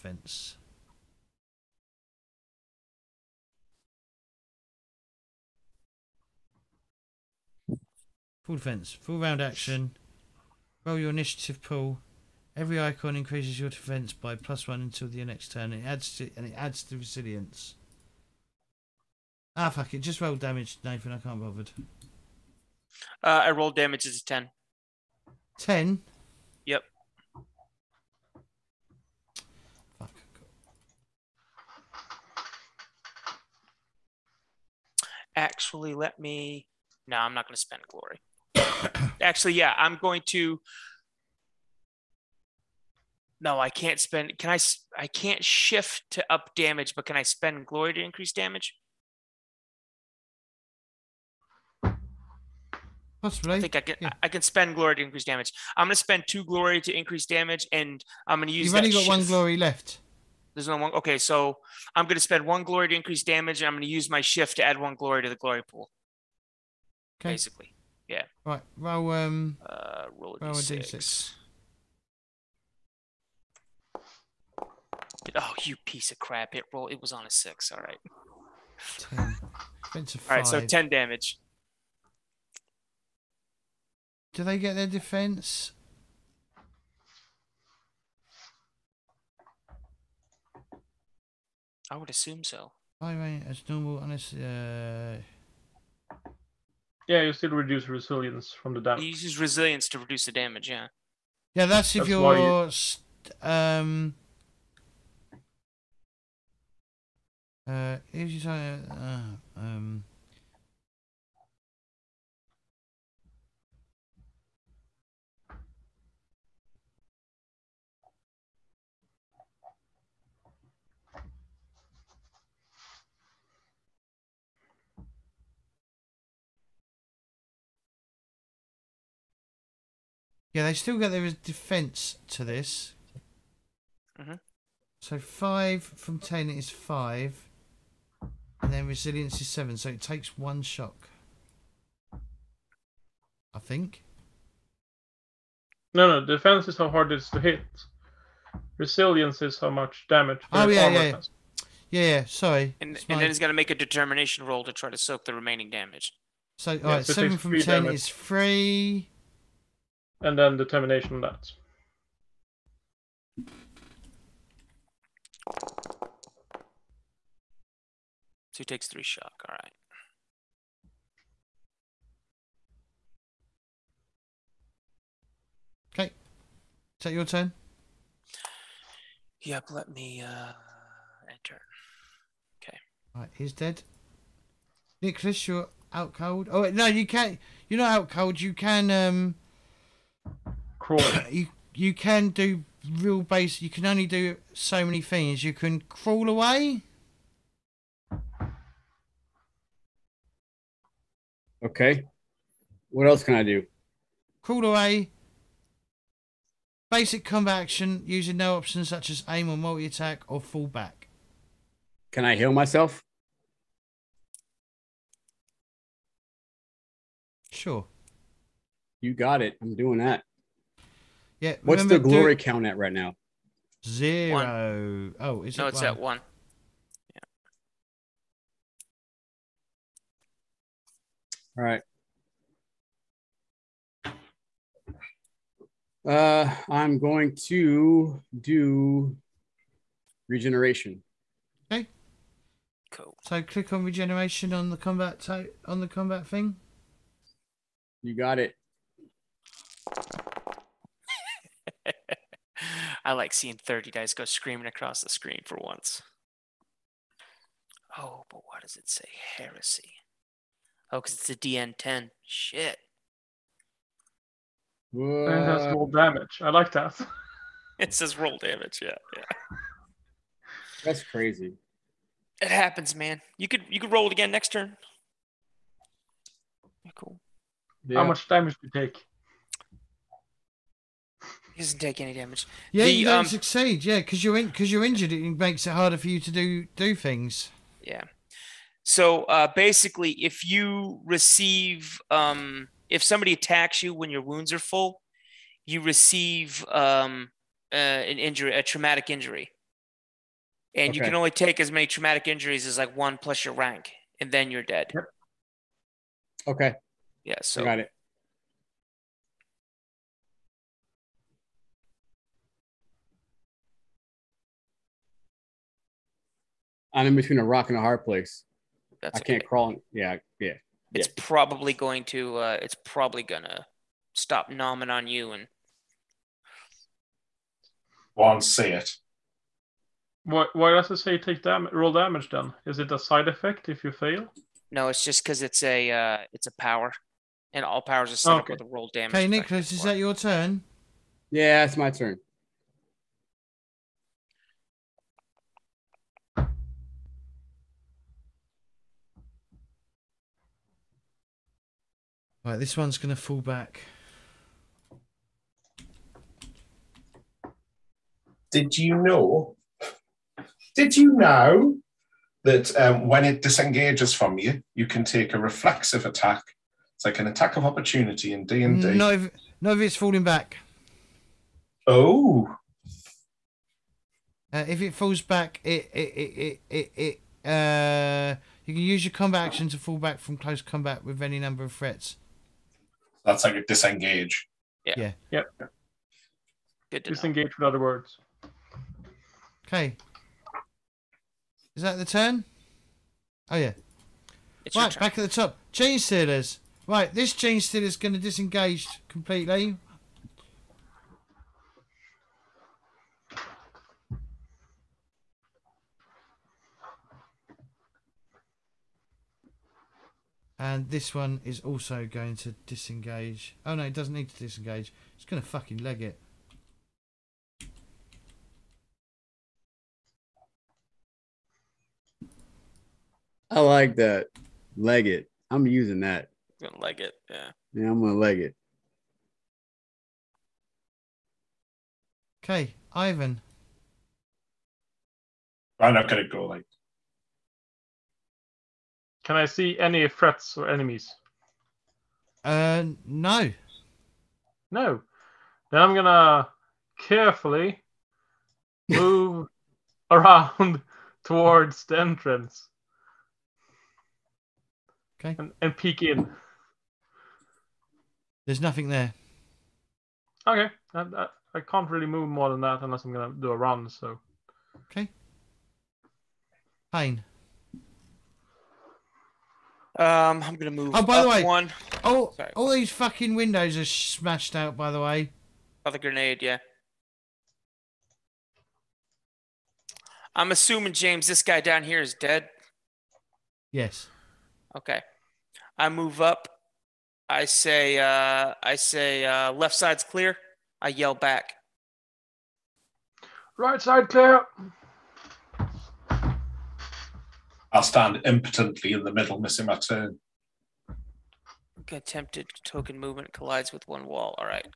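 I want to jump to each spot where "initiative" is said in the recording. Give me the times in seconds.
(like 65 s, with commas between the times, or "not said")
11 s.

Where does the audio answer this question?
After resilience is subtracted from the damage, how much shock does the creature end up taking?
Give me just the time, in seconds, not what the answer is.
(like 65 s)
168 s.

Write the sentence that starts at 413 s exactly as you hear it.
Oh no, it doesn't need to disengage.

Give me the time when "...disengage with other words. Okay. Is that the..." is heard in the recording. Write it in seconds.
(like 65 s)
387 s.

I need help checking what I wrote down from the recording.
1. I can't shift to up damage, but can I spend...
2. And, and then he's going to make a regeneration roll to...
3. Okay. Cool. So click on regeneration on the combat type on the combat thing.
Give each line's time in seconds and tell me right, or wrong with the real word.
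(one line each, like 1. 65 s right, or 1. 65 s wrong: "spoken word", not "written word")
1. 44 s right
2. 152 s wrong: "determination", not "regeneration"
3. 241 s right.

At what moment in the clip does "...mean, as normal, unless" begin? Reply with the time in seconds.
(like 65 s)
93 s.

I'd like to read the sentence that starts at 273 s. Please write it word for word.
You could you could roll it again next turn.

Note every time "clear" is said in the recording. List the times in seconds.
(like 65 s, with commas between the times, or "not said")
490 s, 494 s.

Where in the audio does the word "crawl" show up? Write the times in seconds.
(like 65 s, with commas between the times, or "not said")
190 s, 195 s, 204 s, 319 s.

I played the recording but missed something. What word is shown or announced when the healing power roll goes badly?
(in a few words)
Heresy.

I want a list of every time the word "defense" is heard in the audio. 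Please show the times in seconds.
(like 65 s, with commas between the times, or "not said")
8 s, 13 s, 84 s, 131 s, 146 s.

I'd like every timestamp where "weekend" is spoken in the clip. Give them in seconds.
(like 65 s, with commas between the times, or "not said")
not said.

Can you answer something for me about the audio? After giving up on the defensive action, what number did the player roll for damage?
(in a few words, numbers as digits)
10.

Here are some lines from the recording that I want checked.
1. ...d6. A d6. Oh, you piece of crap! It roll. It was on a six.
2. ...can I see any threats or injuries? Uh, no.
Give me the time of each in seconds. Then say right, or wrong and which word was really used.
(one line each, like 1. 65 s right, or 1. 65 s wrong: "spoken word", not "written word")
1. 70 s right
2. 439 s wrong: "enemies", not "injuries".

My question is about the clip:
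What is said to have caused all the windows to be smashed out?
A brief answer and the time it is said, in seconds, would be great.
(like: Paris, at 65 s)
The grenade, at 475 s.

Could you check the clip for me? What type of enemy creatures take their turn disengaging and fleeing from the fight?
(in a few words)
Genestealers.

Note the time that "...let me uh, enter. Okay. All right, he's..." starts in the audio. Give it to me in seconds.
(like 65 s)
179 s.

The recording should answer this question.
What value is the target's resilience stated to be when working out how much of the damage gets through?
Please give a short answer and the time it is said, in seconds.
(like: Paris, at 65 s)
7, at 138 s.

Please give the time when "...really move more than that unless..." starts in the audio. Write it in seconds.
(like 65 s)
461 s.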